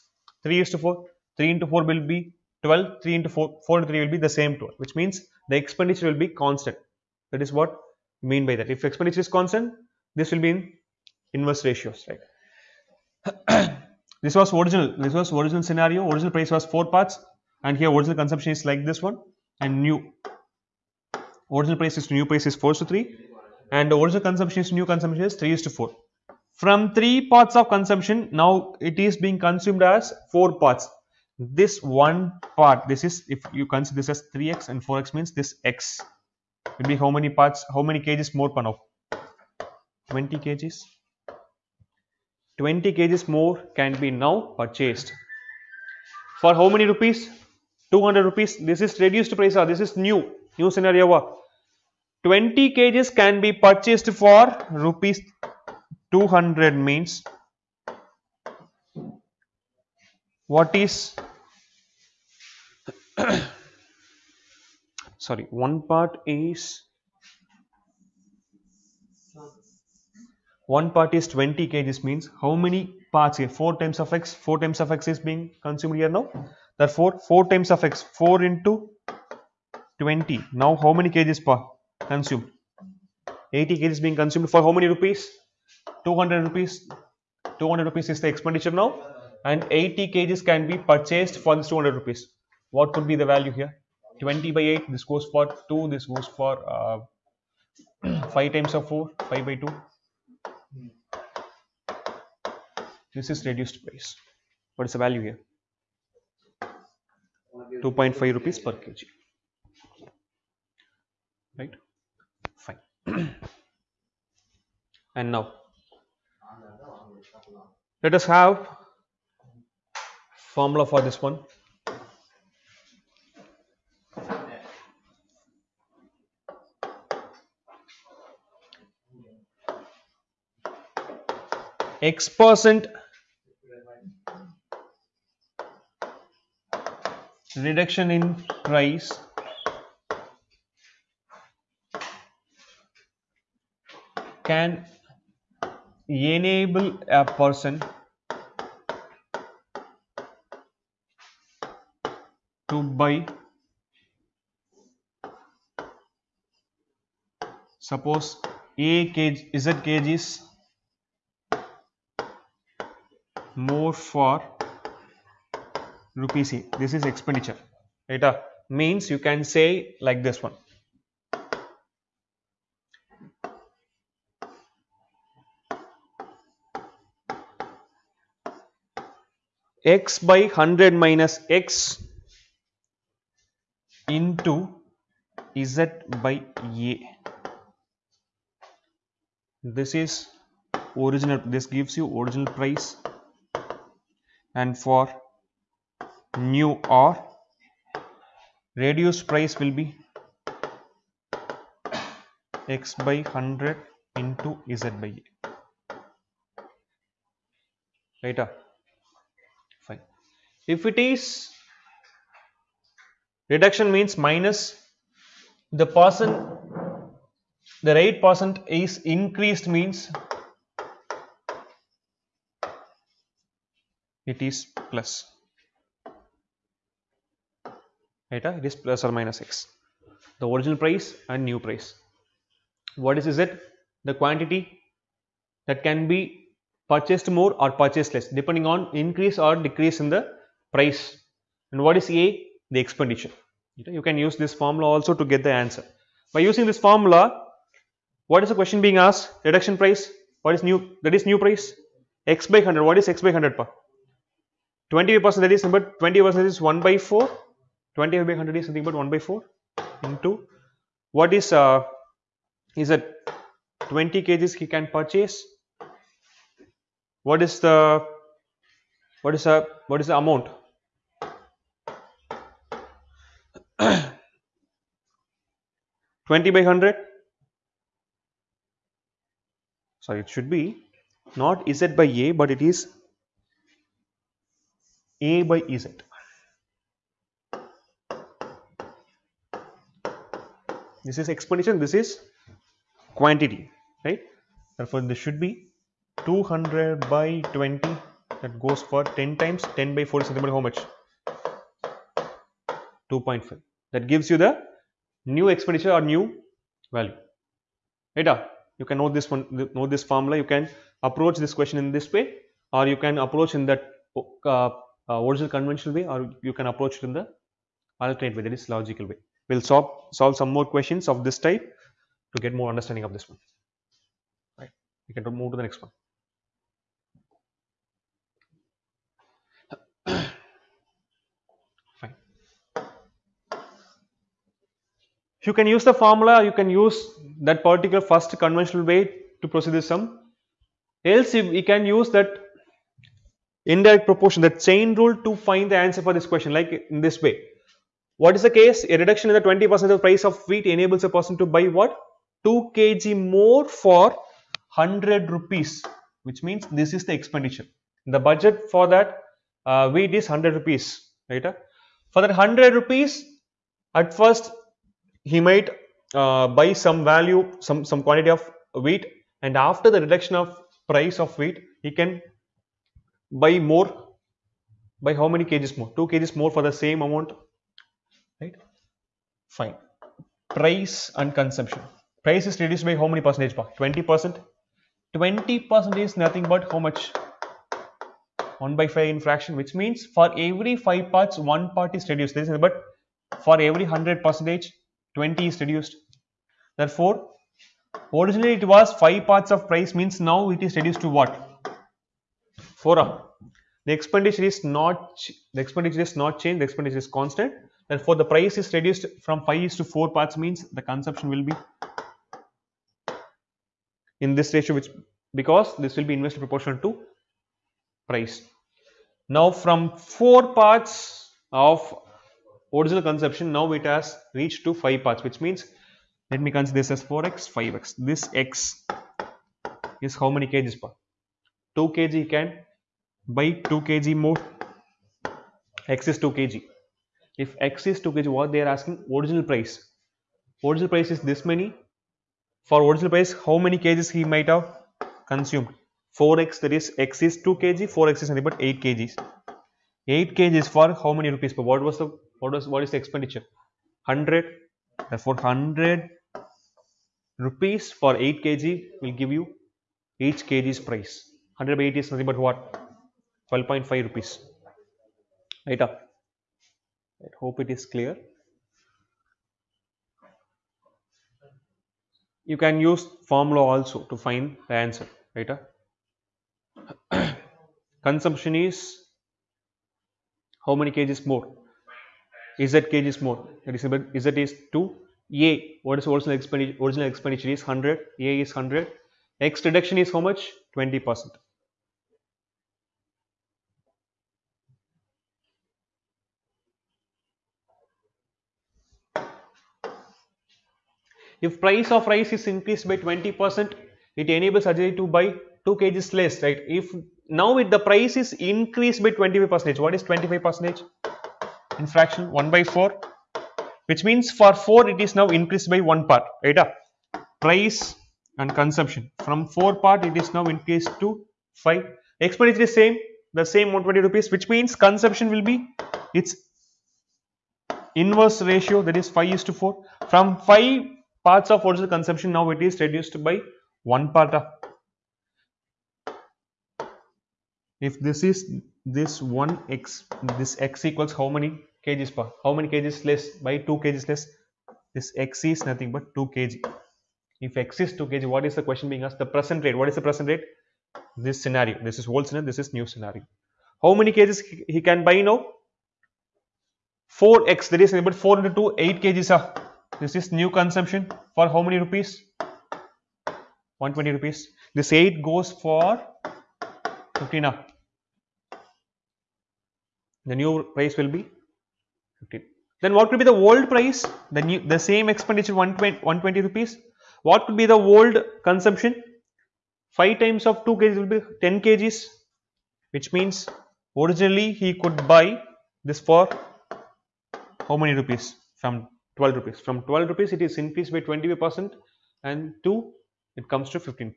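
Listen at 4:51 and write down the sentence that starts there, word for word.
This is exponential, this is quantity, right?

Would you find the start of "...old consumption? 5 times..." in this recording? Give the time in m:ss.
9:37.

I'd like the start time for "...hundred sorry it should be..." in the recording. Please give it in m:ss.
4:36.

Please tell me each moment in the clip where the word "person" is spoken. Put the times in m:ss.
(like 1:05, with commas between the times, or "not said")
2:27, 5:51.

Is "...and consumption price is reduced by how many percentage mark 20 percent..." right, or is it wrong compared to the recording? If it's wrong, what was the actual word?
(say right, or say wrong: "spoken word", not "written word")
right.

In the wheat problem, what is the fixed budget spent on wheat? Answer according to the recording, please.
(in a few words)
100 rupees.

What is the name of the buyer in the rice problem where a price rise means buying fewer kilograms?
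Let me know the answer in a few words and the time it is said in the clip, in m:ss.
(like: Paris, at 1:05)
Ajay, at 8:24.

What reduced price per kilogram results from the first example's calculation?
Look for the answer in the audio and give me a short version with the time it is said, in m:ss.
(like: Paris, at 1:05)
2.5 rupees per kg, at 1:47.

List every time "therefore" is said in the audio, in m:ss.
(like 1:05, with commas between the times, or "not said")
1:16, 4:54, 6:36, 6:47, 7:35.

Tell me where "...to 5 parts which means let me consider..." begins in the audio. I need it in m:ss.
7:04.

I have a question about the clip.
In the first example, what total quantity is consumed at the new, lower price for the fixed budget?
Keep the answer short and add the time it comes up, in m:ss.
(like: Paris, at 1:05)
80 kgs, at 1:22.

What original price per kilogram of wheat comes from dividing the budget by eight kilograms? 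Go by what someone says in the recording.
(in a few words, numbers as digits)
12.5 rupees.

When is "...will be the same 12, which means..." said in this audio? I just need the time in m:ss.
0:04.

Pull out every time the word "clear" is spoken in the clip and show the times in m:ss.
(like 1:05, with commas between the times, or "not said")
7:47.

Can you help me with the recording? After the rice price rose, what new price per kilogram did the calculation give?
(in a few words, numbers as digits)
15.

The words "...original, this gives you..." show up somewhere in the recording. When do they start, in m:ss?
3:10.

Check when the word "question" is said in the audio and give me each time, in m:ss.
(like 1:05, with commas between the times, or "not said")
4:08, 5:11, 5:20, 5:46, 9:08.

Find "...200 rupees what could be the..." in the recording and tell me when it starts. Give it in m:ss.
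1:31.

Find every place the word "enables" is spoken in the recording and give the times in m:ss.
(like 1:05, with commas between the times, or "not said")
2:26, 5:50, 8:24.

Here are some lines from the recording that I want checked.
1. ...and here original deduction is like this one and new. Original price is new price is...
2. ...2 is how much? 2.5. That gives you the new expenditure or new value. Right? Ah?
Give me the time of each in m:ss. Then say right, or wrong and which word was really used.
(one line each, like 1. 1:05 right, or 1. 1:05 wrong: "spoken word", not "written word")
1. 0:17 wrong: "consumption", not "deduction"
2. 5:00 wrong: "4", not "2".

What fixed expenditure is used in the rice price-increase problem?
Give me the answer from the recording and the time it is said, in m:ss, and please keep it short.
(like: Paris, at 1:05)
120 rupees, at 8:43.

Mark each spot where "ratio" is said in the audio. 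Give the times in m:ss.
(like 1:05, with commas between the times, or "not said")
0:11, 6:54, 8:48.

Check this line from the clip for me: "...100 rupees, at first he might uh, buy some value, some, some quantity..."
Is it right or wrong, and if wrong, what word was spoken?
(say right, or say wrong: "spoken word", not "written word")
right.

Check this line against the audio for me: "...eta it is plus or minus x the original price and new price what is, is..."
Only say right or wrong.
right.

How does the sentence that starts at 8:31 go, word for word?
In fraction 1 by 4, which means for 4 it is now increased by 1 part, right?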